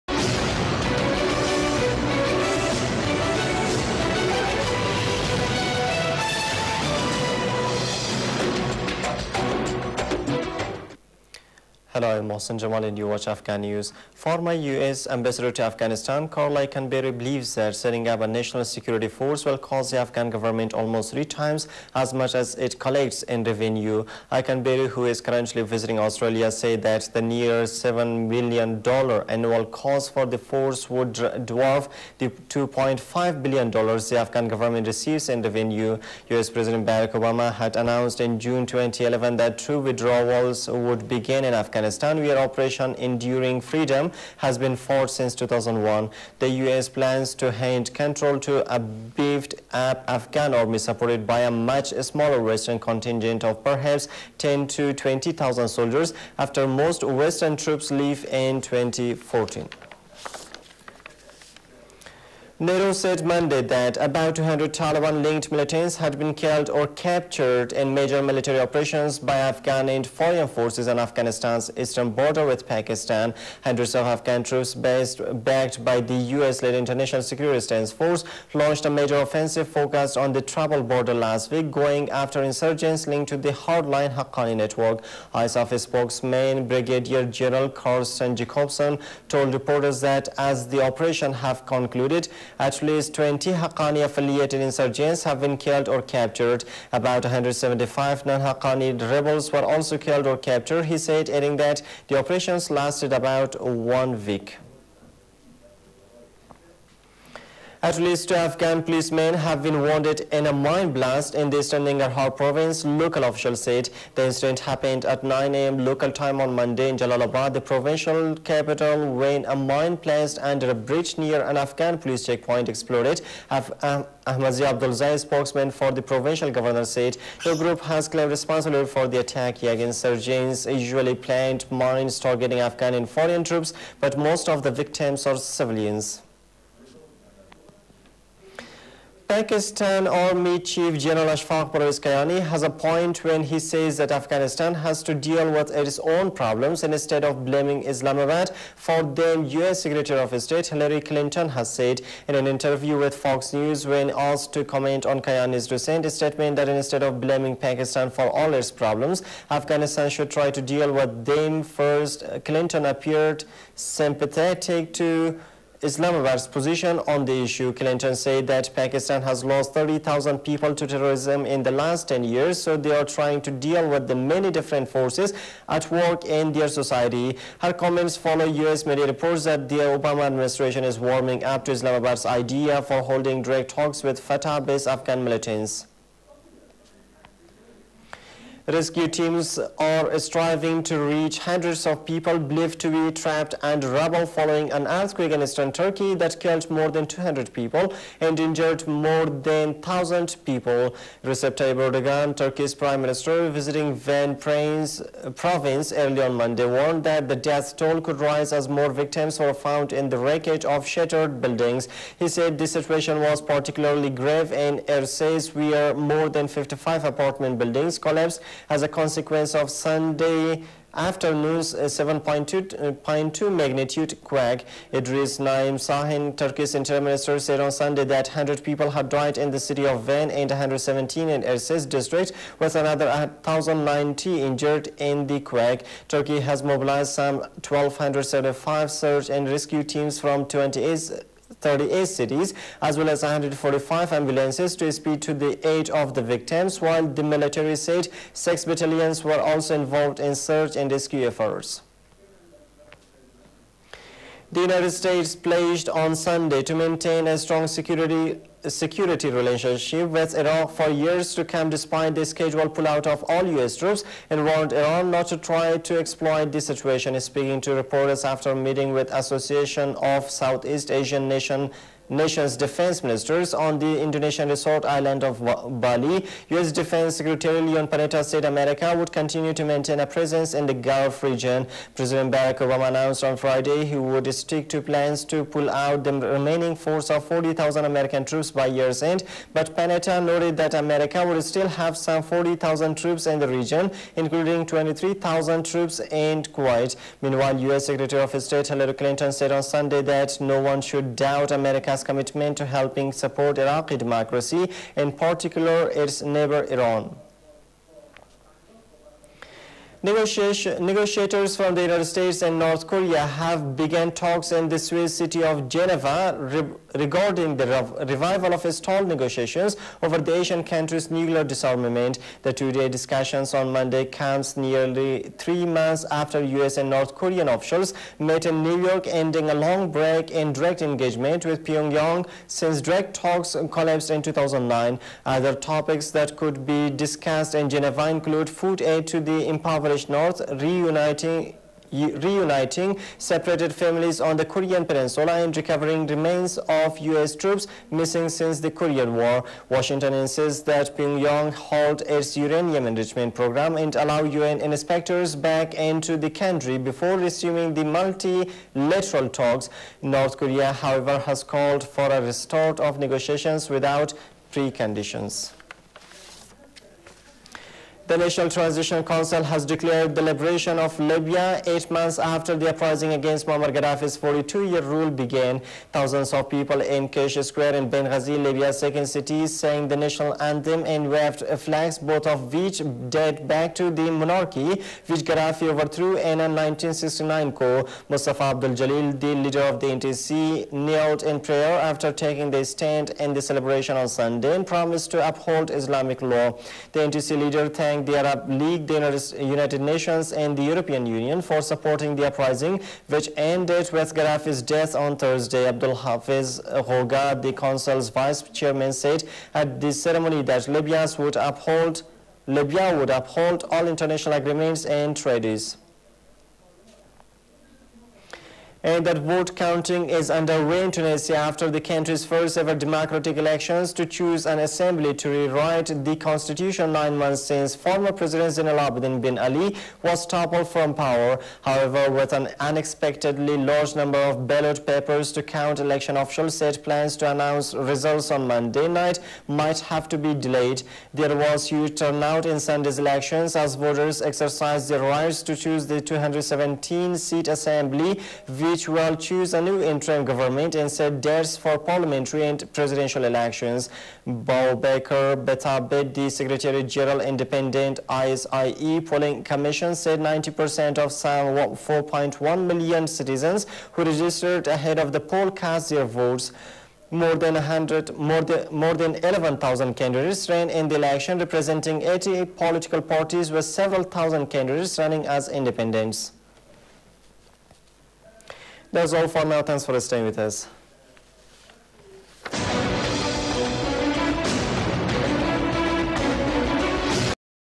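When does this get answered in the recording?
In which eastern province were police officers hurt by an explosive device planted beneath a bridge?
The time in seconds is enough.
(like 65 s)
111 s.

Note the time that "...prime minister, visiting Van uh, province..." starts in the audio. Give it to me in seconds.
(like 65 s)
202 s.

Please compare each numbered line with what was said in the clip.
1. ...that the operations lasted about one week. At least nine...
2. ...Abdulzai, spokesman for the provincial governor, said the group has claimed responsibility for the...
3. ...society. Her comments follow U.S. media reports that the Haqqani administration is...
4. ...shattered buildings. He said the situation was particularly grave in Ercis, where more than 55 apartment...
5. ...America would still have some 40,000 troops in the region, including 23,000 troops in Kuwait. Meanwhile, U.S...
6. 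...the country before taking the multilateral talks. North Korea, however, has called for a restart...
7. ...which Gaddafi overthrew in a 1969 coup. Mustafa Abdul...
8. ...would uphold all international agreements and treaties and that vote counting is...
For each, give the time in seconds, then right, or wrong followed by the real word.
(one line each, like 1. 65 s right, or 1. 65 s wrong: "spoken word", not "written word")
1. 101 s wrong: "two", not "nine"
2. 124 s right
3. 176 s wrong: "Obama", not "Haqqani"
4. 210 s right
5. 290 s right
6. 356 s wrong: "resuming", not "taking"
7. 385 s right
8. 412 s right.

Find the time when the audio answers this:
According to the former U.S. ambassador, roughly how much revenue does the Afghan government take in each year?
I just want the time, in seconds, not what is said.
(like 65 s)
32 s.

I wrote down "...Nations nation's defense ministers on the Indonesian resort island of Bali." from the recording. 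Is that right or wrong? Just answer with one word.
right.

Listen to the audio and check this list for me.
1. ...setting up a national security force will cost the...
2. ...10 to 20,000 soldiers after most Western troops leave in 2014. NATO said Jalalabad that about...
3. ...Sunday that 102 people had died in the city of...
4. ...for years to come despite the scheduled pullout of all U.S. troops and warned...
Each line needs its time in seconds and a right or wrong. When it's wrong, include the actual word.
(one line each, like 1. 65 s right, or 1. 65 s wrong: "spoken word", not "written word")
1. 17 s right
2. 54 s wrong: "Monday", not "Jalalabad"
3. 227 s wrong: "100", not "102"
4. 260 s right.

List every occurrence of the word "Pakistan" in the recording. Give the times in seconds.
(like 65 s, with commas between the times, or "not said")
72 s, 139 s, 157 s, 168 s.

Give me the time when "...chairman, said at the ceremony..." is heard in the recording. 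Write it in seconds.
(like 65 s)
408 s.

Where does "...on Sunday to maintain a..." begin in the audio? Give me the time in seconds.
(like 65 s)
255 s.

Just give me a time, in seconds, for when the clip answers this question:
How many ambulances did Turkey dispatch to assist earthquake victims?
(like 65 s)
243 s.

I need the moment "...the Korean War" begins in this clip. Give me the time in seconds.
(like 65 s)
348 s.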